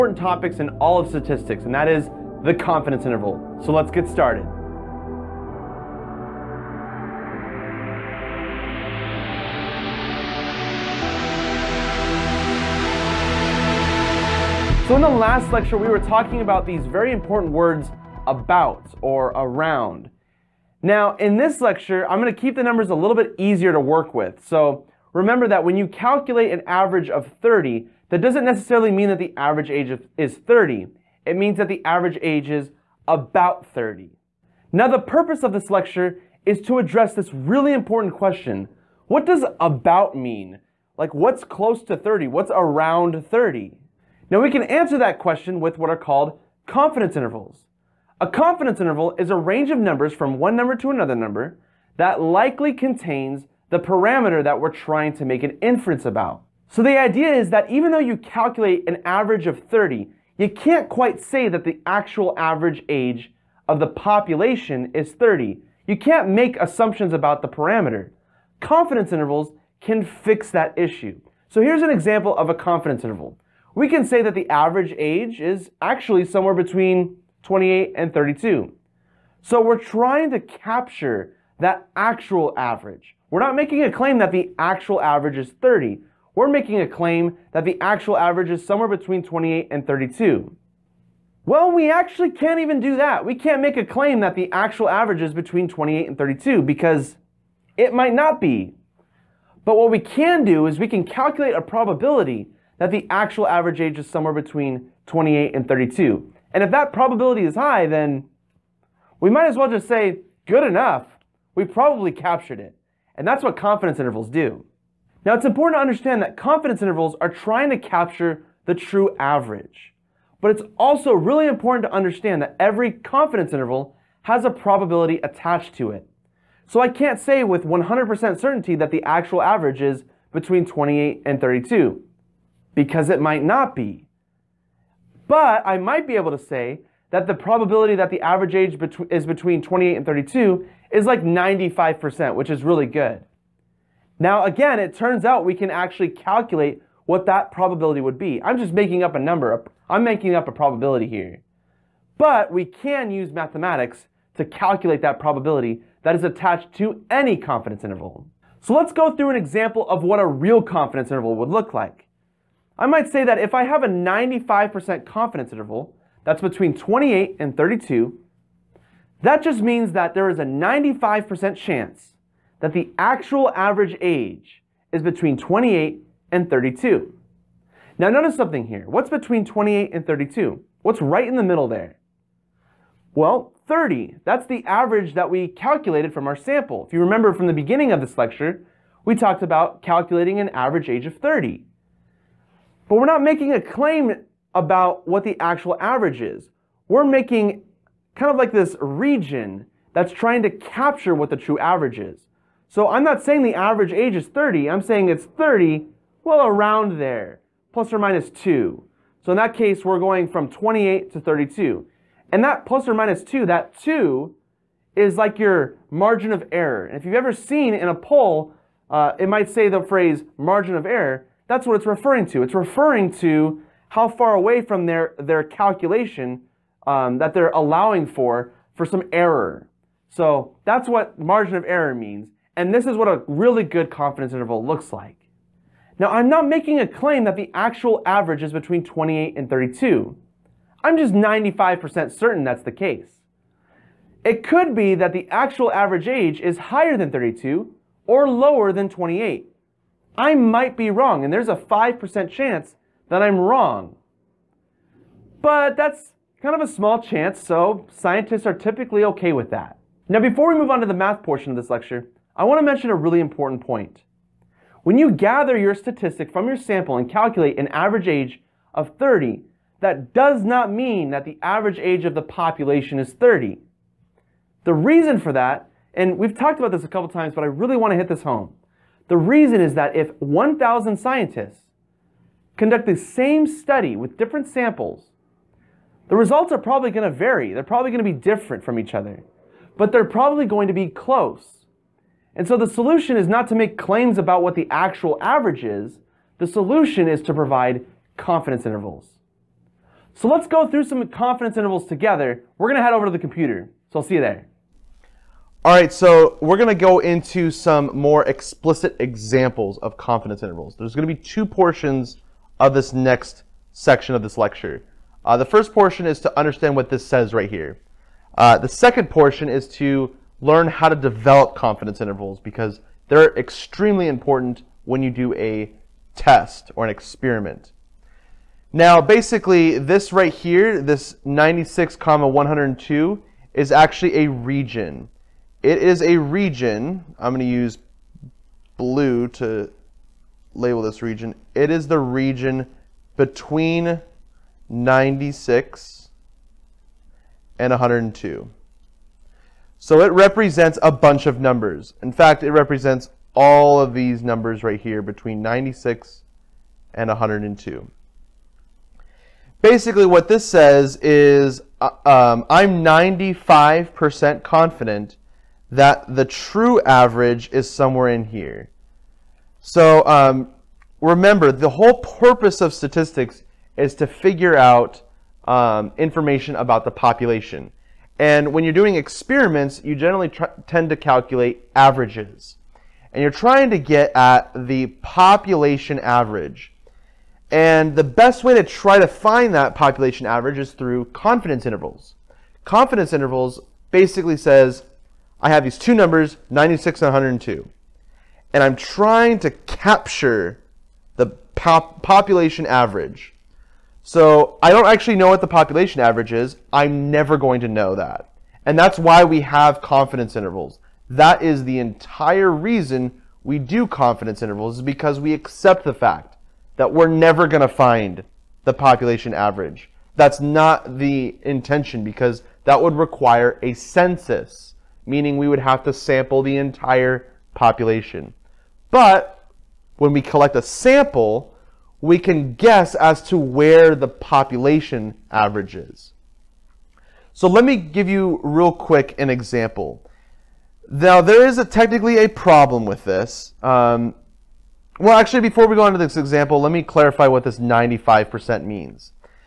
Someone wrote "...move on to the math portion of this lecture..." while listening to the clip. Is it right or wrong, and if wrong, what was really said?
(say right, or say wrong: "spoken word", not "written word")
right.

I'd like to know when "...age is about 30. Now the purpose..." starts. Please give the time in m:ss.
0:32.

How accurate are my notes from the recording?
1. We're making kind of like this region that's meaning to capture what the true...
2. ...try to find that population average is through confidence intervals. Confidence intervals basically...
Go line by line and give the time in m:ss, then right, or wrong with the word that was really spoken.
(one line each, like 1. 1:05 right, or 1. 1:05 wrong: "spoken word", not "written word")
1. 3:16 wrong: "trying", not "meaning"
2. 6:28 right.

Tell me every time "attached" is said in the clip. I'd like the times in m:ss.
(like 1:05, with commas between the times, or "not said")
2:05, 2:36.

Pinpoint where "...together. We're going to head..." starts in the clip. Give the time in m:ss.
5:01.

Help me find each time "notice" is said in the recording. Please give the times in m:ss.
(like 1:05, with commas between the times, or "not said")
2:58.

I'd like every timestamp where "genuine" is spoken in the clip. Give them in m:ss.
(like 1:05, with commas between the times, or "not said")
not said.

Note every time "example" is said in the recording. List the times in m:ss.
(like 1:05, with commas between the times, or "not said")
1:11, 2:39, 5:08, 7:19, 7:26.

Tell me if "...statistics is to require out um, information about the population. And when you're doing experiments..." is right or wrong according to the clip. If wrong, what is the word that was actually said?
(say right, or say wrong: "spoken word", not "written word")
wrong: "figure", not "require".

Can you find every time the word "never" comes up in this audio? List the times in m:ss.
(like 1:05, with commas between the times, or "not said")
6:47, 6:57.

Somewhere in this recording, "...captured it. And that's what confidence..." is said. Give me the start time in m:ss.
1:52.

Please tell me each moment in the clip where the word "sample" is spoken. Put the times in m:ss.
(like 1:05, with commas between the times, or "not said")
3:06, 4:26, 4:44, 7:05, 7:10.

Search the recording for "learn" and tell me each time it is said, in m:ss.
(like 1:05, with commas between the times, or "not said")
5:20.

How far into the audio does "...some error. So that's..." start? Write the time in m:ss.
3:48.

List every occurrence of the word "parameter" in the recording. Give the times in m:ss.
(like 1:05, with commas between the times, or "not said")
0:53, 1:07.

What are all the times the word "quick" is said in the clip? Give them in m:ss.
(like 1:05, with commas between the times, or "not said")
7:18.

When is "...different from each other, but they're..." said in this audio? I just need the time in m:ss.
4:48.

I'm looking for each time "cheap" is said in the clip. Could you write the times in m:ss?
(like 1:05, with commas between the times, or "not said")
not said.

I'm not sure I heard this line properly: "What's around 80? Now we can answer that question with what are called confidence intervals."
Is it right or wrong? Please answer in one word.
wrong.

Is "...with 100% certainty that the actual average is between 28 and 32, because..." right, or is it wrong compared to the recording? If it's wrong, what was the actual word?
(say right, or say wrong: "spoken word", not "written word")
right.